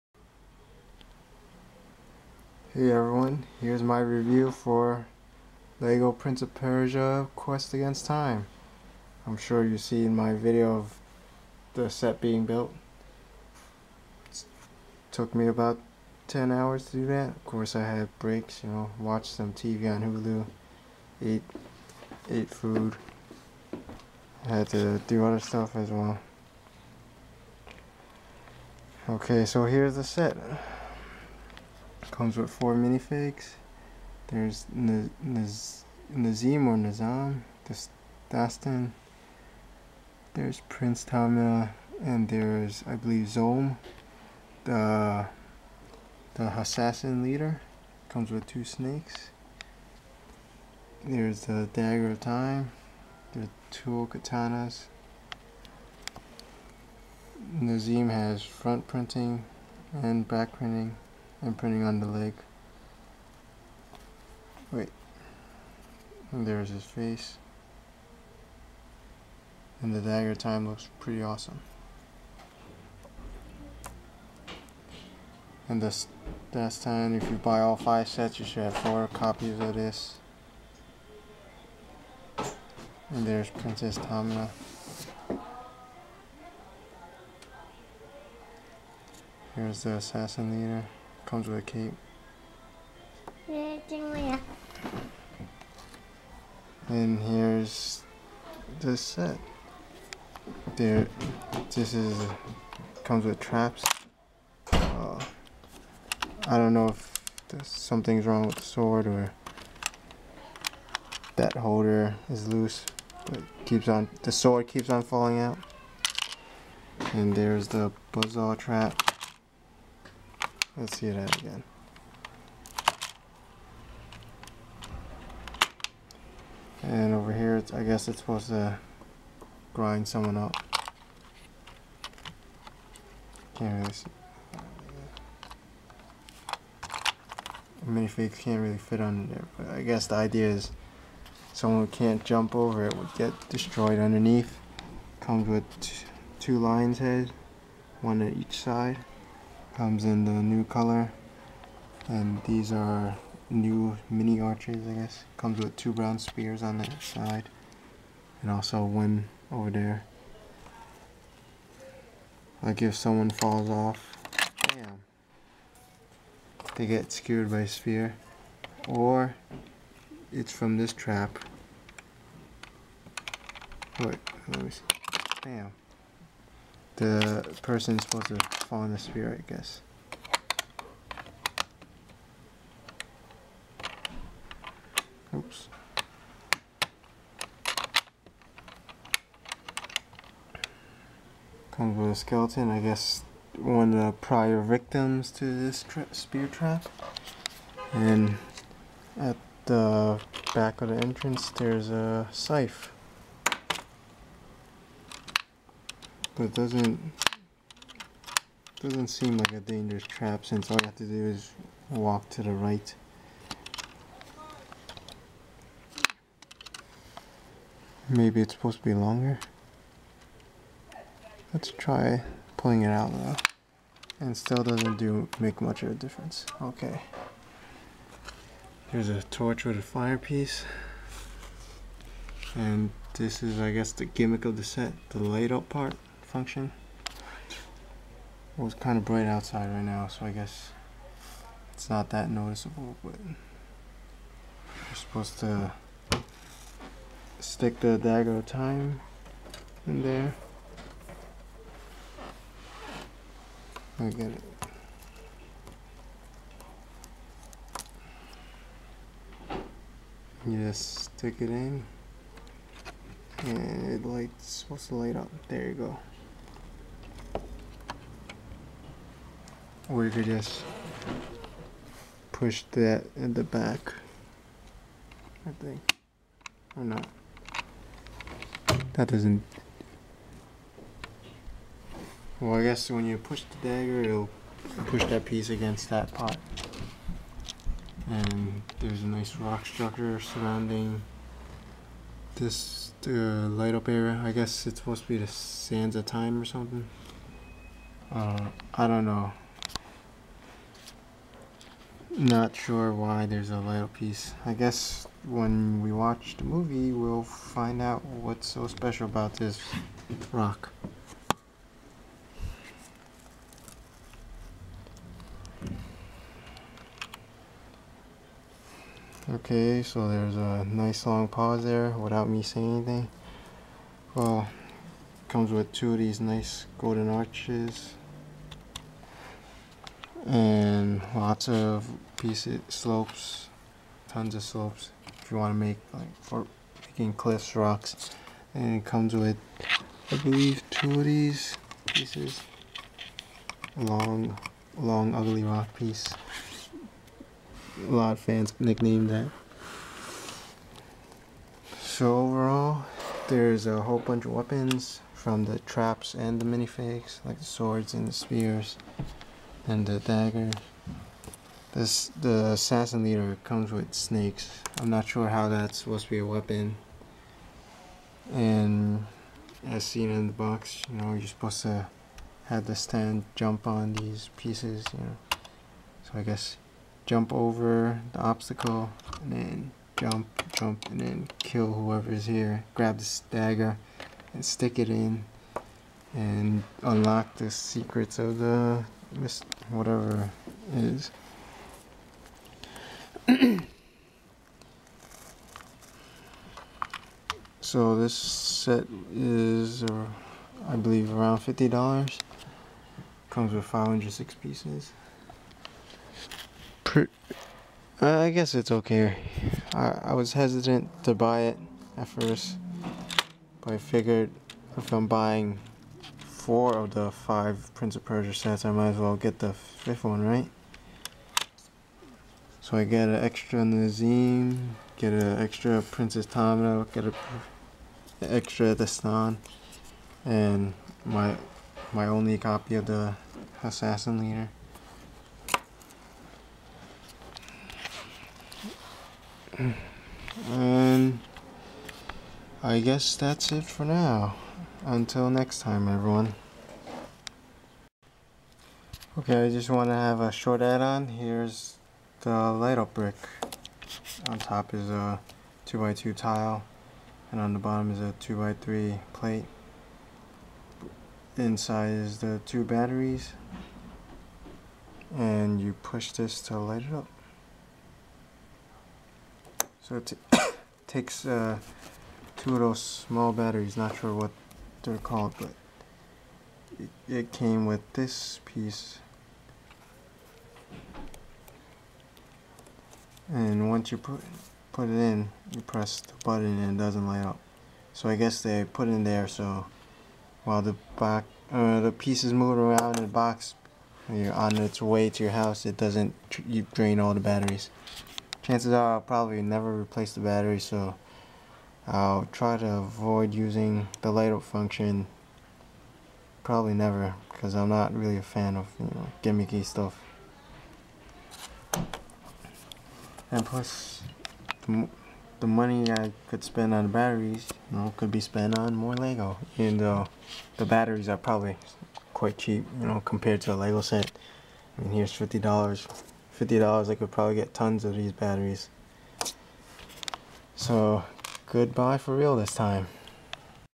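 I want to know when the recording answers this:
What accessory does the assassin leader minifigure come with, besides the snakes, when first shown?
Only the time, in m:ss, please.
1:31.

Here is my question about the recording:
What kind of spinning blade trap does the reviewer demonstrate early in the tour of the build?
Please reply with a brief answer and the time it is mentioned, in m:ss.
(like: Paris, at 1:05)
Buzzsaw, at 1:58.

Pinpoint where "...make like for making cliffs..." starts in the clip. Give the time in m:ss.
5:35.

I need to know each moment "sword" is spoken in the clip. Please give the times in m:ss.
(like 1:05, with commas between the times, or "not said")
1:48, 1:54, 5:57.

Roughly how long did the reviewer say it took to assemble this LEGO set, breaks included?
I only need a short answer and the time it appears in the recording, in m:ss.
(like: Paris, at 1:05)
10 hours, at 0:16.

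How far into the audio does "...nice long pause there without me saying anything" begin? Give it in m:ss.
5:20.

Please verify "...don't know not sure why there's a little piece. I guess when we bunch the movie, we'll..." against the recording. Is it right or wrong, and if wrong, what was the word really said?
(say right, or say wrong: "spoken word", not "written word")
wrong: "watch", not "bunch".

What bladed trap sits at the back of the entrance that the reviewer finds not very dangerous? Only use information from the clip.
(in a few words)
Scythe.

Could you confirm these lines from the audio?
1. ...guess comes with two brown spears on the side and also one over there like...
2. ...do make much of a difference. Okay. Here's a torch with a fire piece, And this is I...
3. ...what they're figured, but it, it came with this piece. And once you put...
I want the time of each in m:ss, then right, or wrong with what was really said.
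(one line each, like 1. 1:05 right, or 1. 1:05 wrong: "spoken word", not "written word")
1. 2:34 right
2. 3:44 right
3. 7:54 wrong: "called", not "figured".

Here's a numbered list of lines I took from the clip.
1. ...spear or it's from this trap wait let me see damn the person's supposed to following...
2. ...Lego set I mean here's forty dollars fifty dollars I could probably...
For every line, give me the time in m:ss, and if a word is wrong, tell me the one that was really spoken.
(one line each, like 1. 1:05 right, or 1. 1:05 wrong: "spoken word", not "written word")
1. 2:47 right
2. 8:43 wrong: "fifty", not "forty".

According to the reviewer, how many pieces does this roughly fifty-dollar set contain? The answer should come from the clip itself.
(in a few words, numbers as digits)
506.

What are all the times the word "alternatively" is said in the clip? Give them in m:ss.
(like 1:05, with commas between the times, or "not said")
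not said.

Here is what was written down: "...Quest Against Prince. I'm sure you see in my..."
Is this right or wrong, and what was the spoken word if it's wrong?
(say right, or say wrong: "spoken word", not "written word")
wrong: "Time", not "Prince".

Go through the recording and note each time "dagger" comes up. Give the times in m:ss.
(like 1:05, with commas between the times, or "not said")
0:51, 1:10, 4:07, 4:43, 5:59, 6:23.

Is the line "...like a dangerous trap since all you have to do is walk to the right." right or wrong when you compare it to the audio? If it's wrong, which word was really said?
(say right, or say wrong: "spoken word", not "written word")
right.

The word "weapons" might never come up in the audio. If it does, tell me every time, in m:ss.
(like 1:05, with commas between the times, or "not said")
5:54, 6:06.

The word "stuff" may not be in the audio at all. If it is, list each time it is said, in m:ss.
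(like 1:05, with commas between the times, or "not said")
0:25, 8:29.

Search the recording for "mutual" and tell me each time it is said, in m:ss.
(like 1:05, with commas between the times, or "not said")
not said.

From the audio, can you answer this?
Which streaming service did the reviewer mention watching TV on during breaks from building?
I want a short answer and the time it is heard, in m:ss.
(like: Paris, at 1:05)
Hulu, at 0:20.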